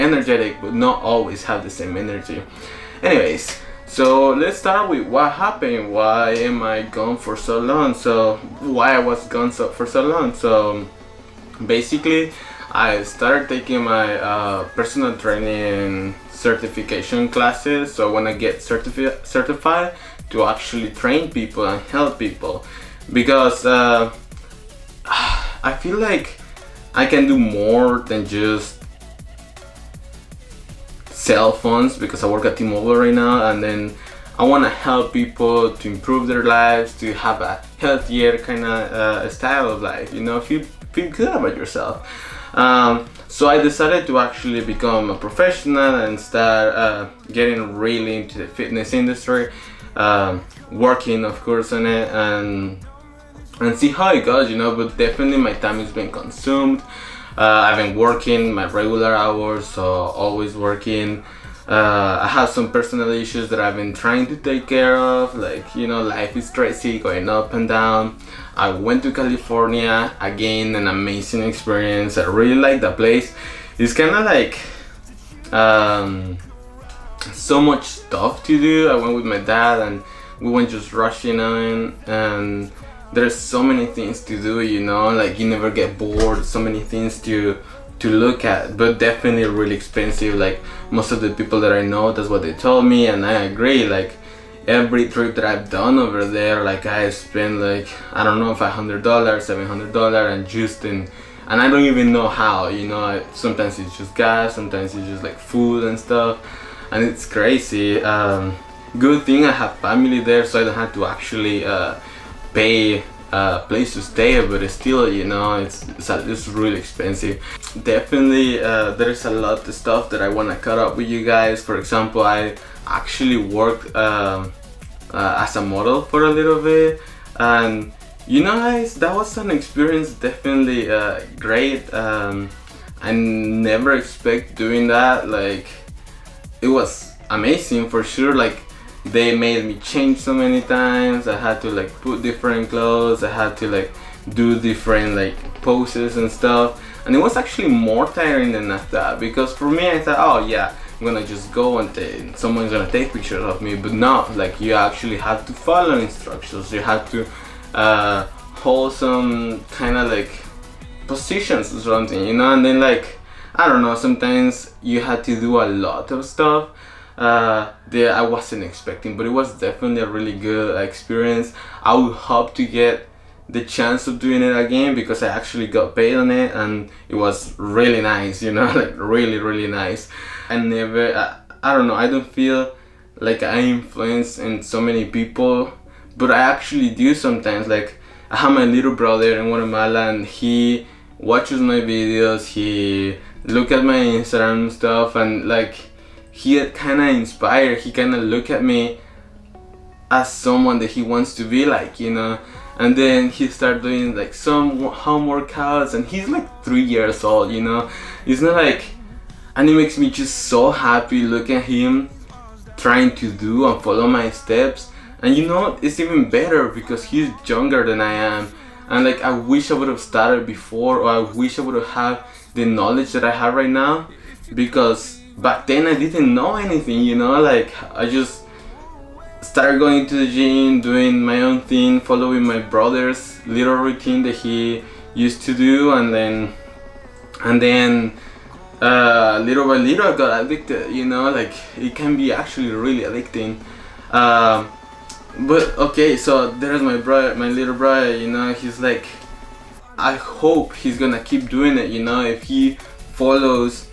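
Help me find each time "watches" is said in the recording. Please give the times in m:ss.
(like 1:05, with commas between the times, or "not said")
3:11.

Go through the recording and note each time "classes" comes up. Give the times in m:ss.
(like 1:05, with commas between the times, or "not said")
0:17.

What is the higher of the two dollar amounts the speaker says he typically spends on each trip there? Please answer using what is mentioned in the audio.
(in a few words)
$700.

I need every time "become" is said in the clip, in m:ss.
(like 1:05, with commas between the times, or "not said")
0:44.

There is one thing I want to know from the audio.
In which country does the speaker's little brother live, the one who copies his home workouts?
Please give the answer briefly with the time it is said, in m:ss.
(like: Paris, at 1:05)
Guatemala, at 3:09.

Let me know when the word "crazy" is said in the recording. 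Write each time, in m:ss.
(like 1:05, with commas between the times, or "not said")
1:06, 1:47.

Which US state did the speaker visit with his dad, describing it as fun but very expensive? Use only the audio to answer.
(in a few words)
California.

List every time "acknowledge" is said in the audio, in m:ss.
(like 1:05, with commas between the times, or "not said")
not said.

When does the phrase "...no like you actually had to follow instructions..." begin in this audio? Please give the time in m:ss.
2:33.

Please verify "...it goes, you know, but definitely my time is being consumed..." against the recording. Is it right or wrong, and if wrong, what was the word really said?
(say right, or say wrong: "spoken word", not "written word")
right.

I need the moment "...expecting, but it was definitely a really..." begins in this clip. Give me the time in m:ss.
2:48.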